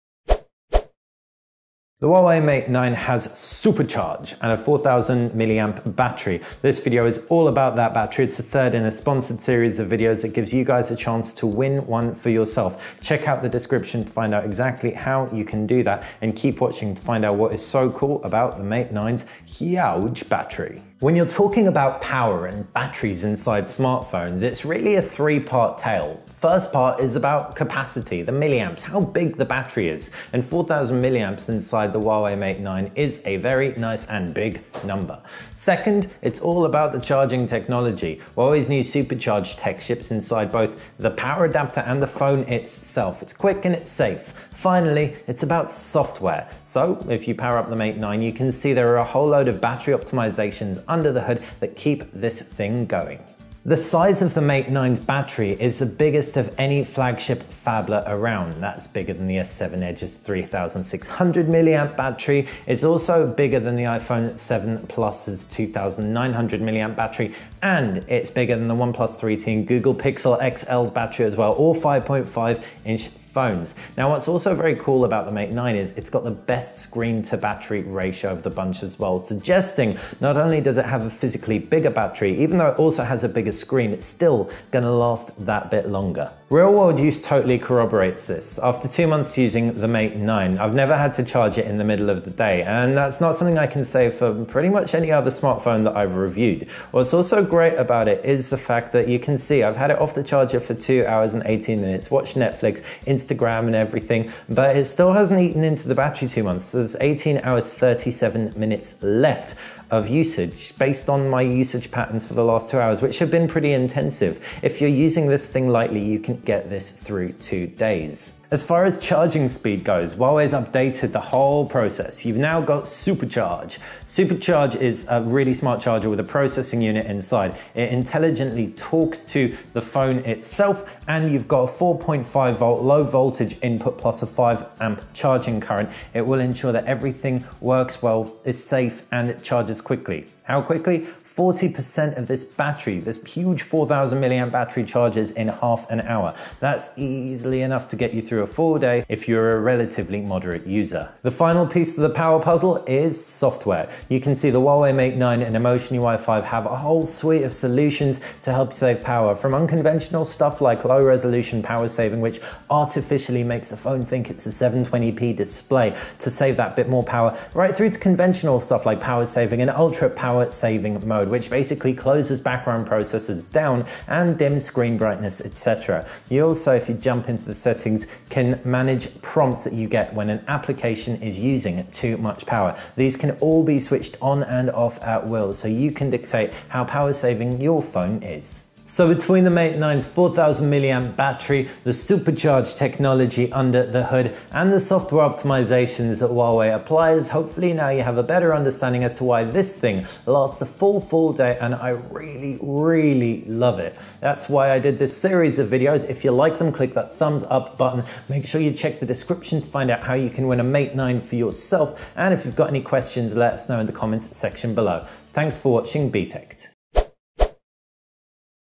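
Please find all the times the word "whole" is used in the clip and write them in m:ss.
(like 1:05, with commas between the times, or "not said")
0:49, 2:01, 2:36.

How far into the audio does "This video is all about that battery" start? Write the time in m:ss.
0:06.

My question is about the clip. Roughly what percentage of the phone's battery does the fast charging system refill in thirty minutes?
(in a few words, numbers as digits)
40%.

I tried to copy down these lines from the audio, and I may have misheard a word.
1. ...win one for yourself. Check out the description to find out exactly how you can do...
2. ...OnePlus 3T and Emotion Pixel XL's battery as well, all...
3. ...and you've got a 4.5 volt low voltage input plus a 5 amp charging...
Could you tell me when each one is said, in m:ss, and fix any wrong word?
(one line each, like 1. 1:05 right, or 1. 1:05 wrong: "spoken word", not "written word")
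1. 0:11 right
2. 1:08 wrong: "Google", not "Emotion"
3. 2:11 right.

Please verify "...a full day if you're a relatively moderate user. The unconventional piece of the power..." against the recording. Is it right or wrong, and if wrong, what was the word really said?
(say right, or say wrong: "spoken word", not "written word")
wrong: "final", not "unconventional".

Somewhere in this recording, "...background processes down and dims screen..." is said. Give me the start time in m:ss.
2:52.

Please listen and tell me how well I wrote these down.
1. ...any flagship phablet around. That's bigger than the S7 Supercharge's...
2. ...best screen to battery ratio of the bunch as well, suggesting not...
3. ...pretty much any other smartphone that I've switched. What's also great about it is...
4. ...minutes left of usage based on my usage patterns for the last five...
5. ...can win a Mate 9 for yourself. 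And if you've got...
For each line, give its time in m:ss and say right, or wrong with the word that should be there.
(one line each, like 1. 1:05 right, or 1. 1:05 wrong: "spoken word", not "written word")
1. 0:56 wrong: "Edge", not "Supercharge"
2. 1:16 right
3. 1:34 wrong: "reviewed", not "switched"
4. 1:48 wrong: "two", not "five"
5. 3:30 right.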